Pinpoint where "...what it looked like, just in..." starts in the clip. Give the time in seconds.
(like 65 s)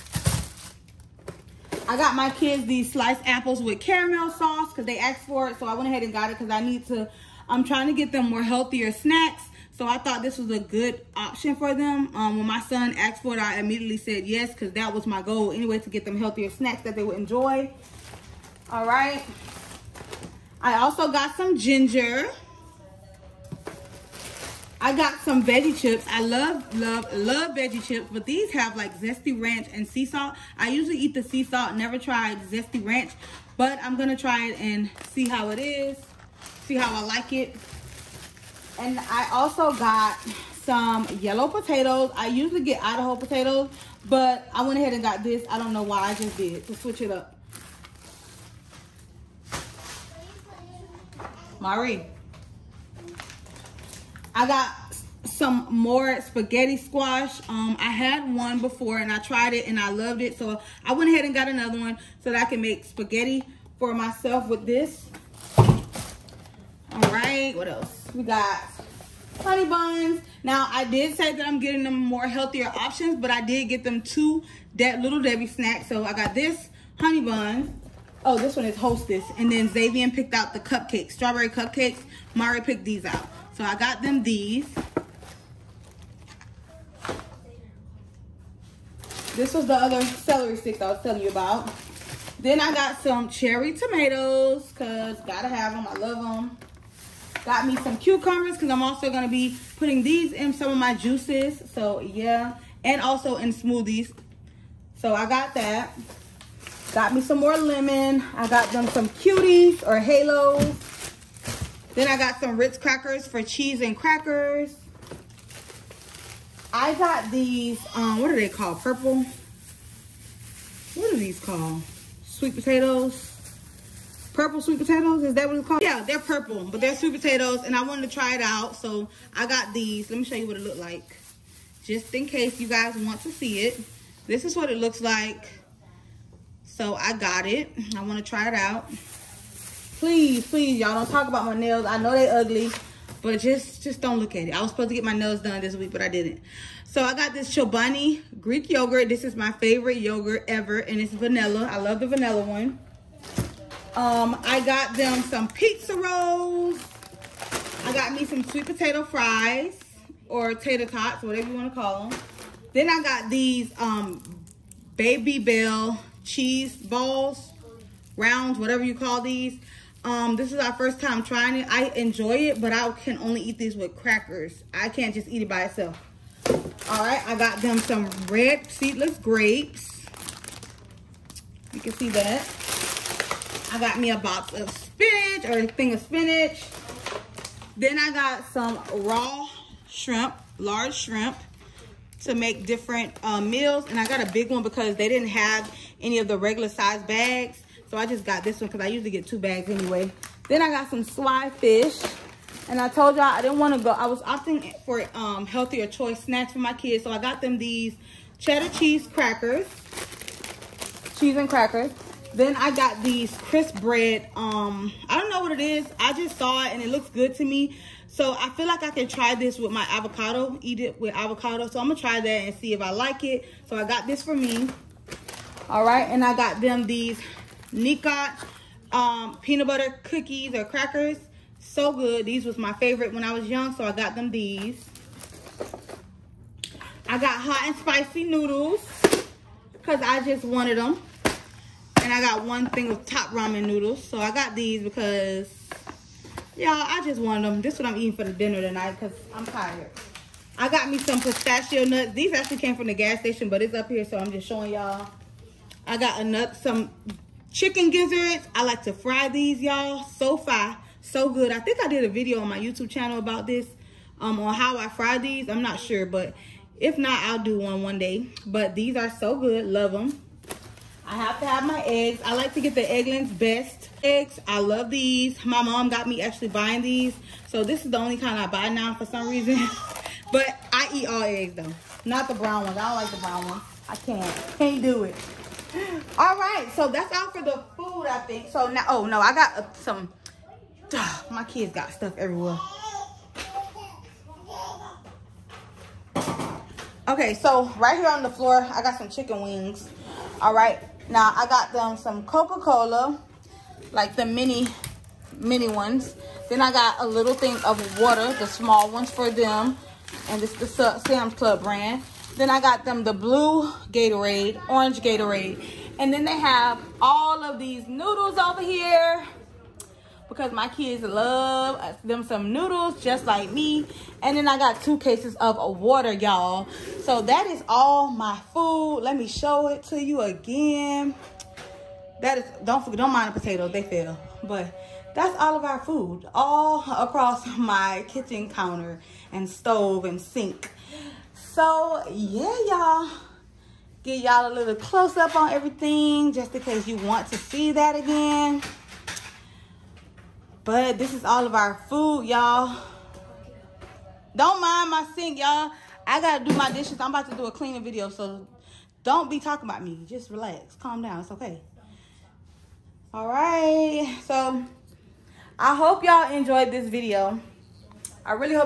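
130 s.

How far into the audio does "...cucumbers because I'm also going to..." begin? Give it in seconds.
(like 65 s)
97 s.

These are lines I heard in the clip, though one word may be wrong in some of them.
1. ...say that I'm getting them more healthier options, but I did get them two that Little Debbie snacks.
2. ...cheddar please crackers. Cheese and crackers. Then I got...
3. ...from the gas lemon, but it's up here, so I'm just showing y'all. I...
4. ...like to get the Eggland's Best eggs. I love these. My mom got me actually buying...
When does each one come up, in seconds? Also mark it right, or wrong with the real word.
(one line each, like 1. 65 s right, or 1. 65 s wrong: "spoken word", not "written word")
1. 71 s right
2. 208 s wrong: "cheese", not "please"
3. 252 s wrong: "station", not "lemon"
4. 272 s right.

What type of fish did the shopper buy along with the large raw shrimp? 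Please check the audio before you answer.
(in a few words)
swai.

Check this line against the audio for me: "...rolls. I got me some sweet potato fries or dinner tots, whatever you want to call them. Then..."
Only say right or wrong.
wrong.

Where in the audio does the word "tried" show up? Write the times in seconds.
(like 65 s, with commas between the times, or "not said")
31 s, 59 s.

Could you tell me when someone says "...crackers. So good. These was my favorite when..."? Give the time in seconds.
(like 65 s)
230 s.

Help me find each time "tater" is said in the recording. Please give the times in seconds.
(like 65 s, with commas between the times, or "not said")
160 s.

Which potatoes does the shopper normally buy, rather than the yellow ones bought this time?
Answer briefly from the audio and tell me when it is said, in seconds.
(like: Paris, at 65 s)
Idaho potatoes, at 42 s.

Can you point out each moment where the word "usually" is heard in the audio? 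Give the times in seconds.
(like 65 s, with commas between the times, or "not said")
30 s, 42 s, 198 s.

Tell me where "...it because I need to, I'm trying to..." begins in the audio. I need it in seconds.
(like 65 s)
6 s.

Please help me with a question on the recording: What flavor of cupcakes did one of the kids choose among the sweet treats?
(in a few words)
strawberry.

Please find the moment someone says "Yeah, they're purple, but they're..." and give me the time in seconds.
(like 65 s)
125 s.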